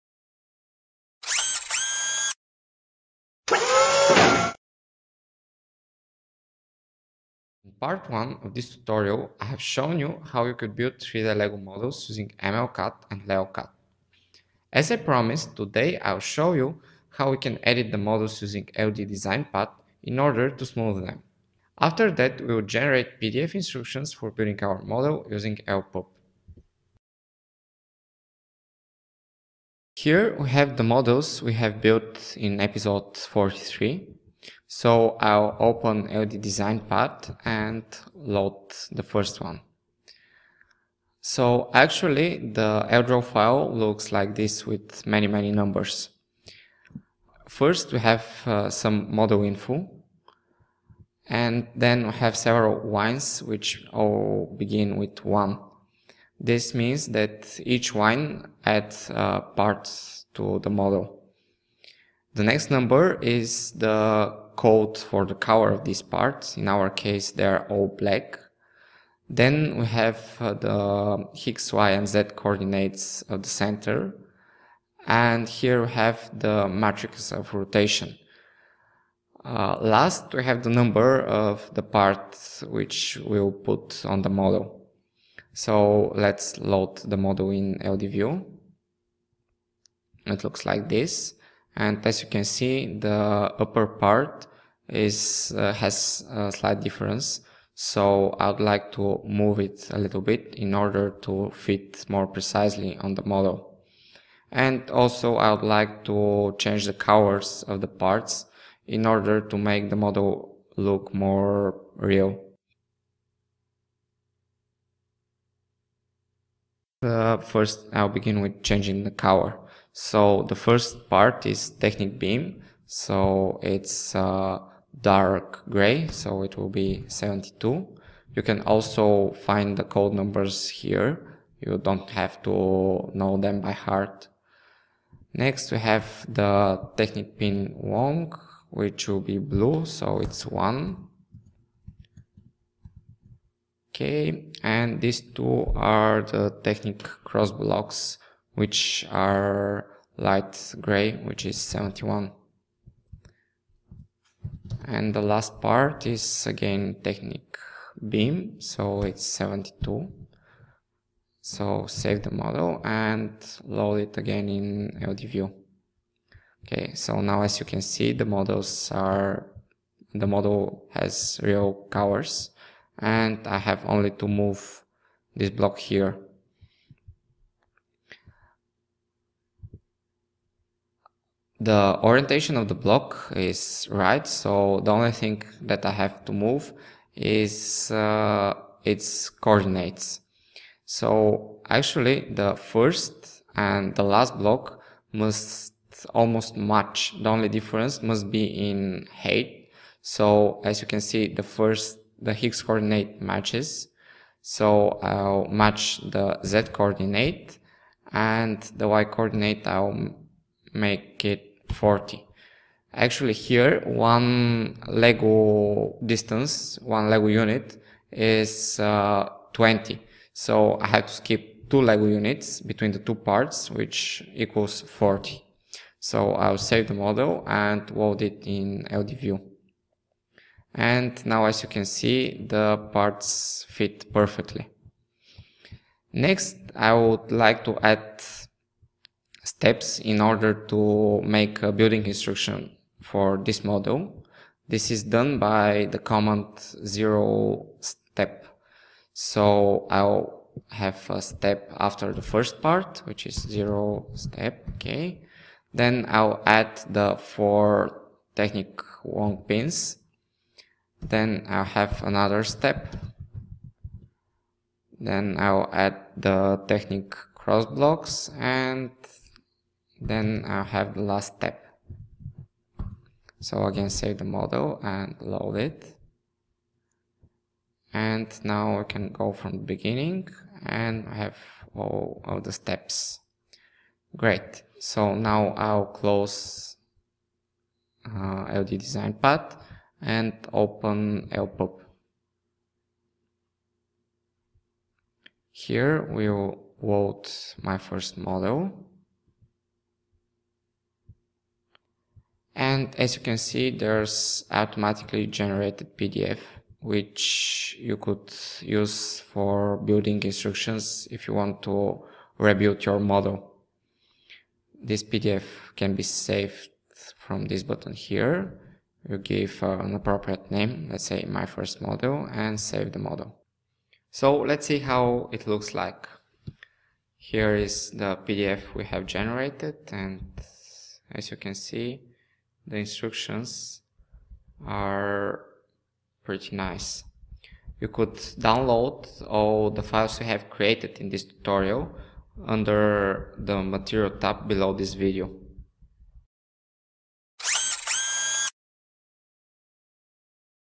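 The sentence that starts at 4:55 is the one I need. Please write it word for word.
Here we'll load my first model.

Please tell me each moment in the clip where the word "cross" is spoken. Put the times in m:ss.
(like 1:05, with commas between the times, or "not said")
2:27, 4:27.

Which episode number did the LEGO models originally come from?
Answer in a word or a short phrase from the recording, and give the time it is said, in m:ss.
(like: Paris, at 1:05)
43, at 0:32.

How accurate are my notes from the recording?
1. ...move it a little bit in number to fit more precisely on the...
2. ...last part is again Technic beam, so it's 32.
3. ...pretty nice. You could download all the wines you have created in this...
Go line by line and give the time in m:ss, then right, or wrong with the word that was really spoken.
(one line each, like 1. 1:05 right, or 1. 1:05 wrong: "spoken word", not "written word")
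1. 1:39 wrong: "order", not "number"
2. 2:35 wrong: "72", not "32"
3. 5:36 wrong: "files", not "wines".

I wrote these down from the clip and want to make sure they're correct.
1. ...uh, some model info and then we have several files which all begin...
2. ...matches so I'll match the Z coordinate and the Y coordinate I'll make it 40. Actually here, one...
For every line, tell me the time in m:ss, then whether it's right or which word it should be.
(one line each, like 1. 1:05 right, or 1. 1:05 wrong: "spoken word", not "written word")
1. 0:48 wrong: "wines", not "files"
2. 3:23 right.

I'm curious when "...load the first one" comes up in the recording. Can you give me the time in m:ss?
0:38.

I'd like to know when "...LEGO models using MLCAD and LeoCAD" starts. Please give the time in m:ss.
0:11.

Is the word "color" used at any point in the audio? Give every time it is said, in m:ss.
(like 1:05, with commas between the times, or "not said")
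1:05, 1:46, 1:59, 2:51.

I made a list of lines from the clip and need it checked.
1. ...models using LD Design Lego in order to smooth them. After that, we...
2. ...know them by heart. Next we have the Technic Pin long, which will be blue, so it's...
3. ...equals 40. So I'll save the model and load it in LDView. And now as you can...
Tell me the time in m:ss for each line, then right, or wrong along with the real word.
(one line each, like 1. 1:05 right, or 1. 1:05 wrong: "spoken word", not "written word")
1. 0:17 wrong: "Pad", not "Lego"
2. 2:13 right
3. 3:44 right.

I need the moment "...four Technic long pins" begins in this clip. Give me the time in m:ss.
4:17.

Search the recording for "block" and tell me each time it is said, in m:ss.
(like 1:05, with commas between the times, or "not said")
2:27, 2:55, 3:02, 3:14, 4:27.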